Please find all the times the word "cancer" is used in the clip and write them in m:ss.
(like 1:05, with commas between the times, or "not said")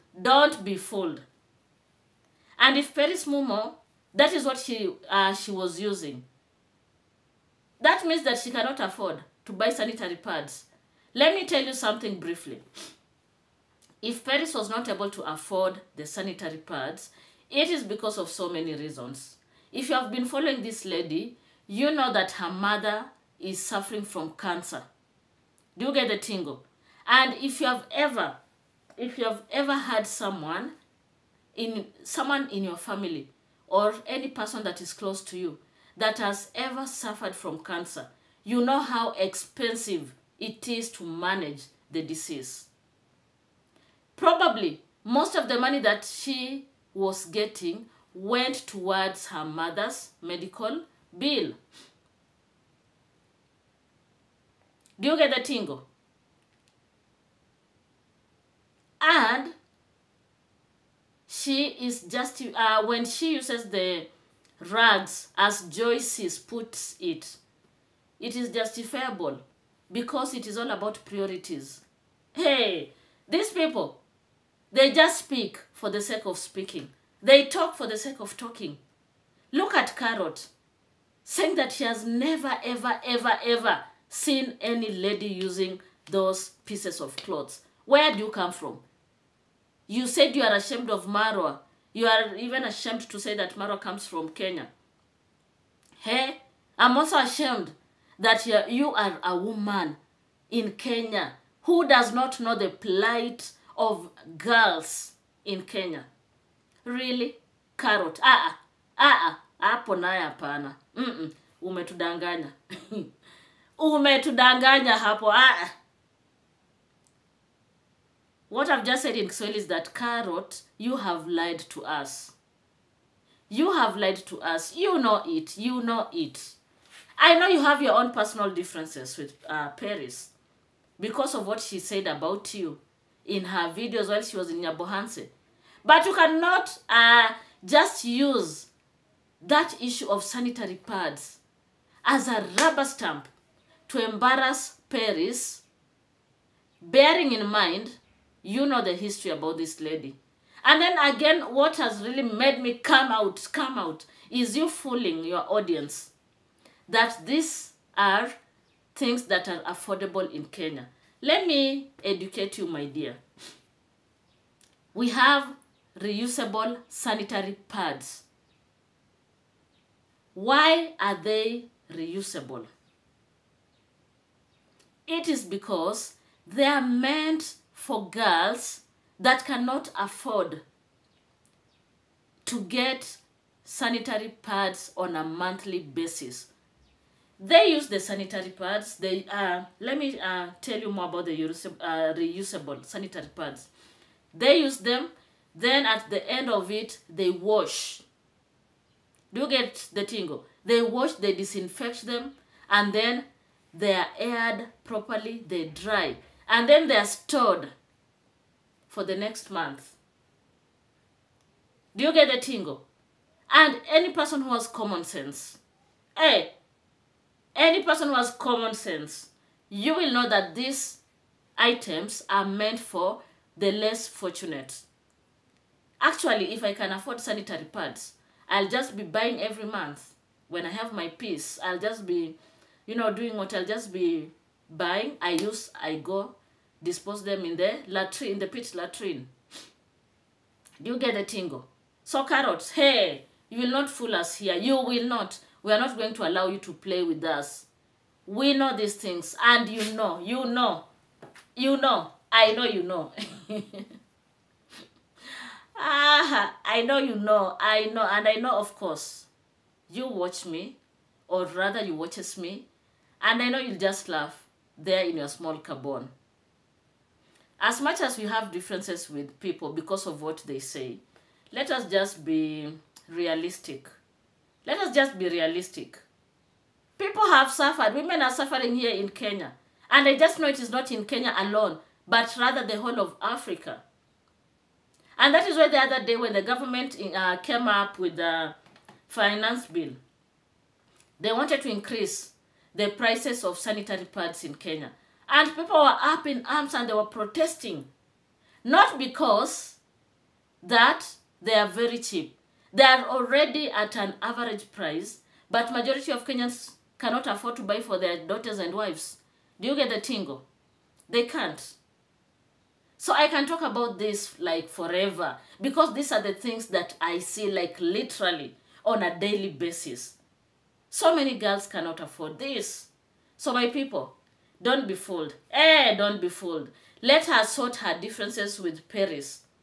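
0:24, 0:37.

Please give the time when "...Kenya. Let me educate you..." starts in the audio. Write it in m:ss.
2:40.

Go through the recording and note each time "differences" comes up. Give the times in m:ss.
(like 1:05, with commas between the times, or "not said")
2:08, 4:28, 5:28.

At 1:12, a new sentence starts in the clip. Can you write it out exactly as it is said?
Hey, these people, they just speak for the sake of speaking.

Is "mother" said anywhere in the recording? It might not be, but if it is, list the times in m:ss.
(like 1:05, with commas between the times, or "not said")
0:22, 0:49.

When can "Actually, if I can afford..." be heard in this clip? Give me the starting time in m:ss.
3:46.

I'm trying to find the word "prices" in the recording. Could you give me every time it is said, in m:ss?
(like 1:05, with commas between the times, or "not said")
4:52, 5:04.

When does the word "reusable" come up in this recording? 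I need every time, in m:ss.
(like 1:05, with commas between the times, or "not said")
2:45, 2:51, 3:12.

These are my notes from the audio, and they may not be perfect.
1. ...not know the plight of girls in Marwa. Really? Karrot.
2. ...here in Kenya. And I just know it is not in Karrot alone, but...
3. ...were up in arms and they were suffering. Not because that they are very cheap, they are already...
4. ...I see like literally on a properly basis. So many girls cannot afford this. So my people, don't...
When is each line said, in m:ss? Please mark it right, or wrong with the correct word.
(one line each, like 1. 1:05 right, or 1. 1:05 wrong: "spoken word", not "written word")
1. 1:42 wrong: "Kenya", not "Marwa"
2. 4:38 wrong: "Kenya", not "Karrot"
3. 4:55 wrong: "protesting", not "suffering"
4. 5:17 wrong: "daily", not "properly".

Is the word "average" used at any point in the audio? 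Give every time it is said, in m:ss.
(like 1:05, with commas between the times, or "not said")
5:04.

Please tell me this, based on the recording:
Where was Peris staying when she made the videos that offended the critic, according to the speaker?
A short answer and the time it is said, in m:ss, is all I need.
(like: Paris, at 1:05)
Nyabohanse, at 2:14.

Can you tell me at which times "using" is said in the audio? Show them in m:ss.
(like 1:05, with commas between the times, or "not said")
0:05, 1:25.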